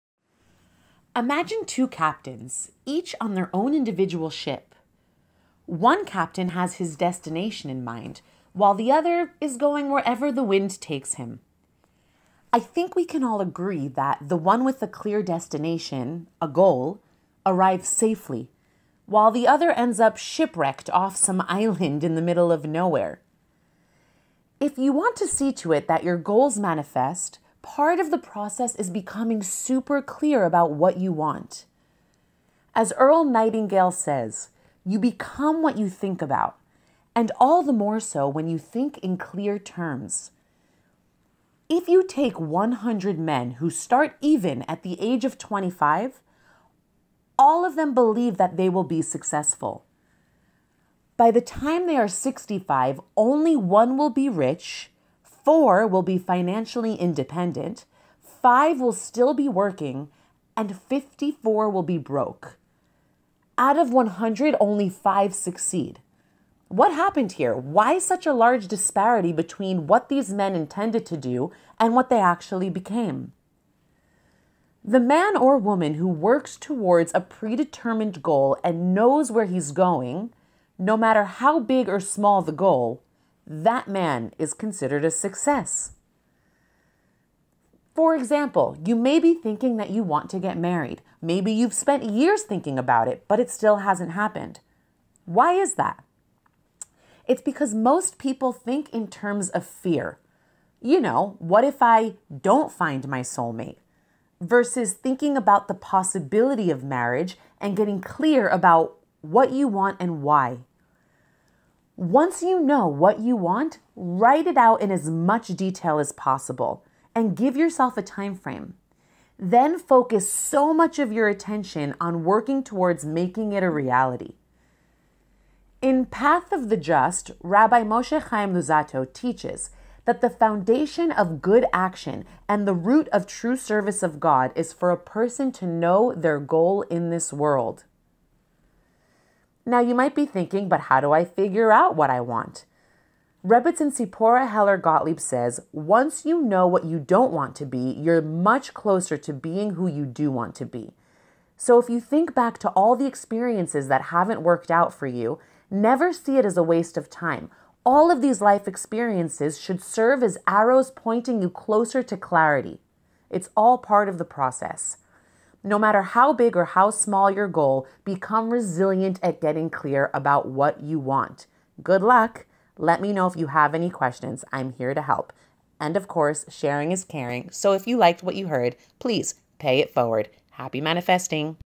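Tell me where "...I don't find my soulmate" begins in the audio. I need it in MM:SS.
01:41.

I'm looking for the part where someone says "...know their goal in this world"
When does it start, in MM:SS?
02:15.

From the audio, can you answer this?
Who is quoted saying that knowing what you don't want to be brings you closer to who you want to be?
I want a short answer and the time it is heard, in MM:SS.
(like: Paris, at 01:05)
Sipora Heller Gottlieb, at 02:23.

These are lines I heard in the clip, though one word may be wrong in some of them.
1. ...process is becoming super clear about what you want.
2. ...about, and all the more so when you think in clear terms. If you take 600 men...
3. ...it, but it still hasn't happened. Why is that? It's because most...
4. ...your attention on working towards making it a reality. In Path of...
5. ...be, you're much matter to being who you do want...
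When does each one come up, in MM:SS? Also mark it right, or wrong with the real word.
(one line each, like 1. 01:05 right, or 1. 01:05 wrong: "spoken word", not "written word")
1. 00:28 right
2. 00:36 wrong: "100", not "600"
3. 01:33 right
4. 02:01 right
5. 02:27 wrong: "closer", not "matter".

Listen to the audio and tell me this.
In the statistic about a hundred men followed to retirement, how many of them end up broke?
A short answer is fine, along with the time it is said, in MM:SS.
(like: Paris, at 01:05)
54, at 01:00.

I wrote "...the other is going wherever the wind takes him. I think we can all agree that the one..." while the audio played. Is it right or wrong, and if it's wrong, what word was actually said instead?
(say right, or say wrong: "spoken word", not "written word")
right.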